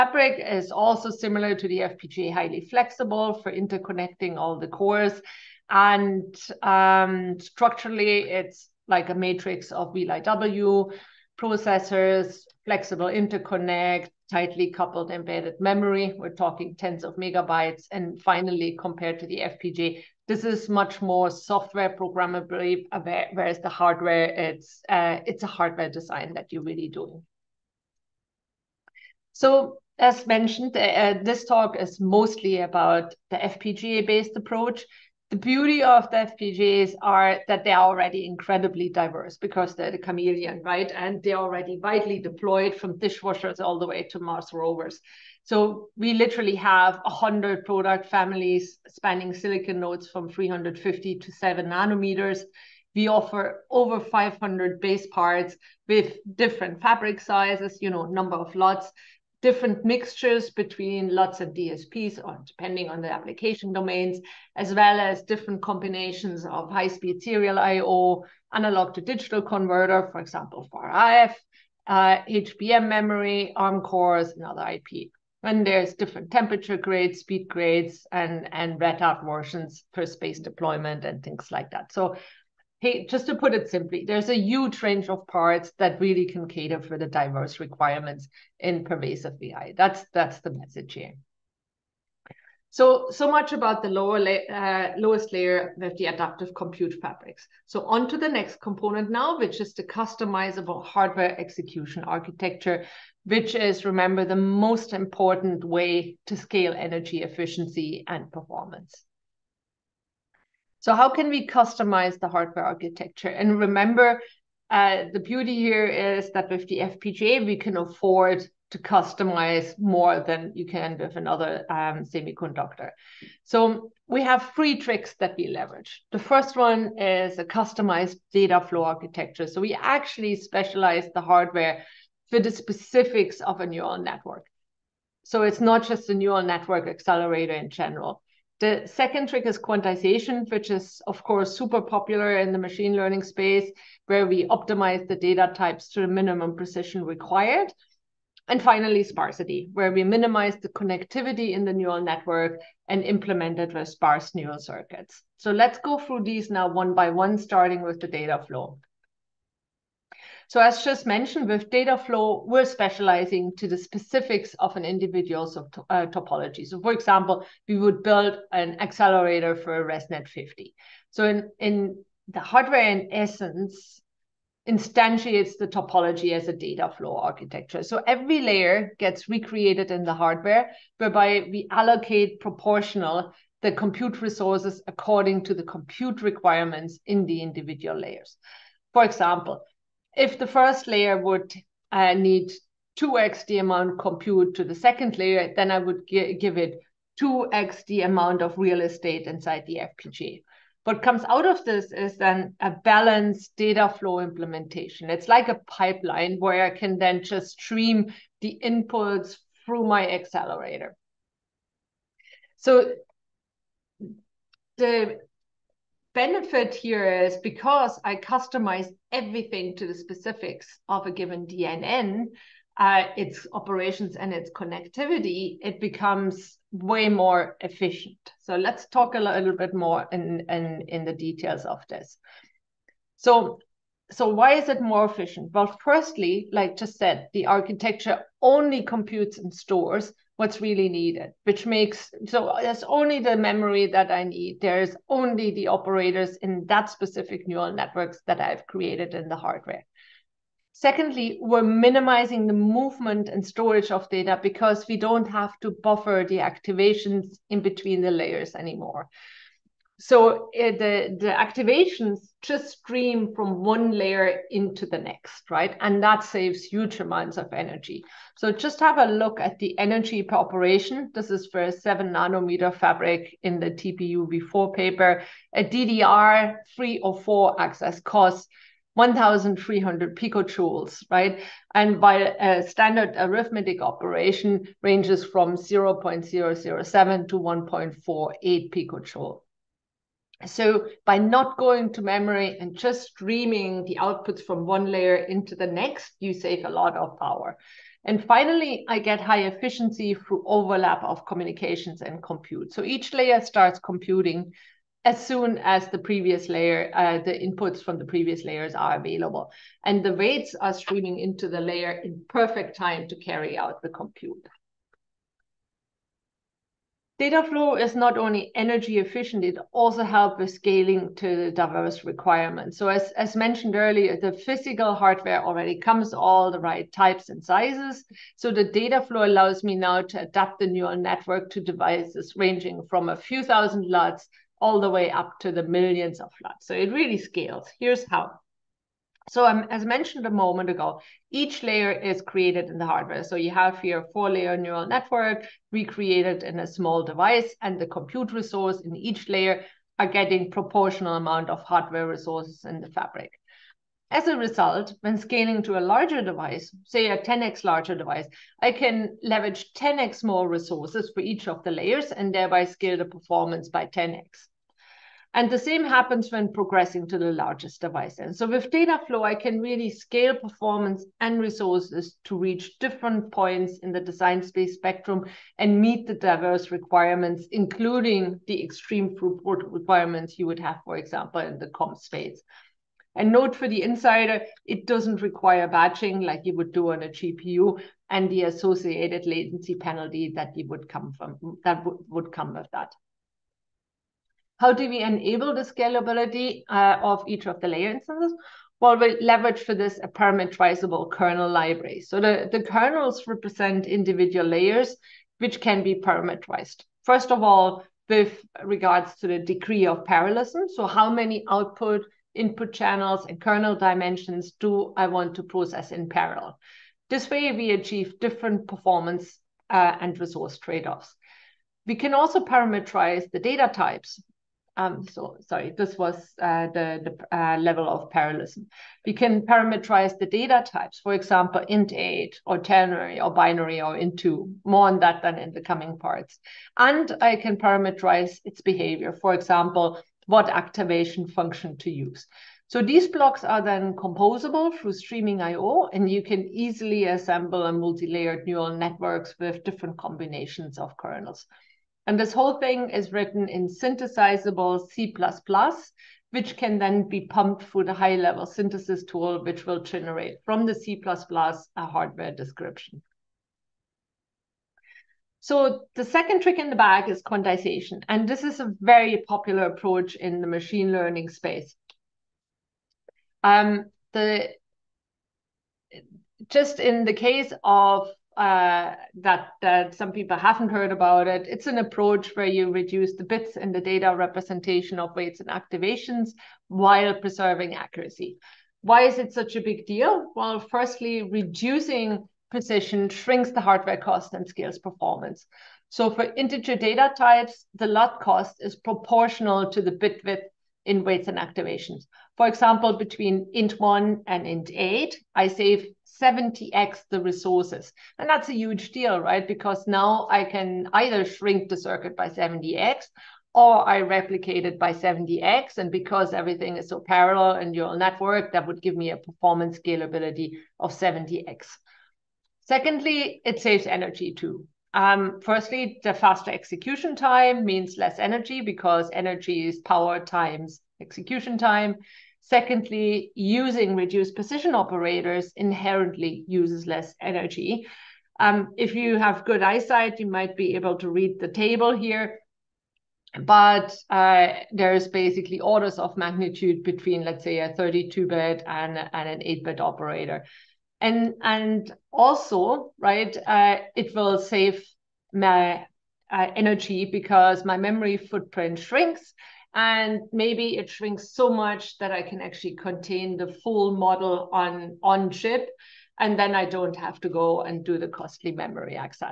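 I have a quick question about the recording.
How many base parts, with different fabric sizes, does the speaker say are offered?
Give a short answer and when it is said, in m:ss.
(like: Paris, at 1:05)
over 500, at 0:53.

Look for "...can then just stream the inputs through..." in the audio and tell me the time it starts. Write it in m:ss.
3:26.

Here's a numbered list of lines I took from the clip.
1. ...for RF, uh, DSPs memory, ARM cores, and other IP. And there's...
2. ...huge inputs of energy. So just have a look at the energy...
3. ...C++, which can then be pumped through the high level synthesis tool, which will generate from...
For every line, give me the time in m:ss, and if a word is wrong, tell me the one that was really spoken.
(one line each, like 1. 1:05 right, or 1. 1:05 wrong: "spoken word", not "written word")
1. 1:10 wrong: "HBM", not "DSPs"
2. 4:26 wrong: "amounts", not "inputs"
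3. 7:34 right.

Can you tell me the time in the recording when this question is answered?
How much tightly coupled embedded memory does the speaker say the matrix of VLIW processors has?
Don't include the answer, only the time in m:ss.
0:16.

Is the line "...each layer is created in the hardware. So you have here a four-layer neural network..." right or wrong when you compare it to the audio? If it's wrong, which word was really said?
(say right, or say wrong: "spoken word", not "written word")
right.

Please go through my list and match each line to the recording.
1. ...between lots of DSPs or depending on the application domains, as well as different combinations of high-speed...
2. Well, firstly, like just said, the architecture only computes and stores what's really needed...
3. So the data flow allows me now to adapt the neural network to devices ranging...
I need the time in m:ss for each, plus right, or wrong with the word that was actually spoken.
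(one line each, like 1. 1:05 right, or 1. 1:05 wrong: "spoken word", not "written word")
1. 1:00 right
2. 3:55 right
3. 5:28 right.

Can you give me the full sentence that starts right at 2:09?
So we actually specialize the hardware for the specifics of a neural network.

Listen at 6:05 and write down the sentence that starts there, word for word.
And the same happens when progressing to the largest device.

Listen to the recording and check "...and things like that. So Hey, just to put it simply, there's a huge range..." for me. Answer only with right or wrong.
right.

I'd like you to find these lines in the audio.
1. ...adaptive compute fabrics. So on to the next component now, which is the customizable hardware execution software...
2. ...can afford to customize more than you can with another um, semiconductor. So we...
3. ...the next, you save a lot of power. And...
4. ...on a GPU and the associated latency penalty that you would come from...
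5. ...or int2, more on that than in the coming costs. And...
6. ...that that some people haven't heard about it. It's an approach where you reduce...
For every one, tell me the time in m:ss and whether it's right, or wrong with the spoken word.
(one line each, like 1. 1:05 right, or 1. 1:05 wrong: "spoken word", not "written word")
1. 1:36 wrong: "architecture", not "software"
2. 1:57 right
3. 4:55 right
4. 6:26 right
5. 7:13 wrong: "parts", not "costs"
6. 7:59 right.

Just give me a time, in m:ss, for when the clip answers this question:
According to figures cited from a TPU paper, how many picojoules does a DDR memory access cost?
4:38.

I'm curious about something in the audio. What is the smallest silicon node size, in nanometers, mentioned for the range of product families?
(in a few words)
350.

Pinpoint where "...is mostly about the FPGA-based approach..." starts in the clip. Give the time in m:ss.
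0:31.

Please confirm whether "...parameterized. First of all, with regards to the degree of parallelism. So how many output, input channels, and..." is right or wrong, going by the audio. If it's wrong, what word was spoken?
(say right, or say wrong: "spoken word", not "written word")
right.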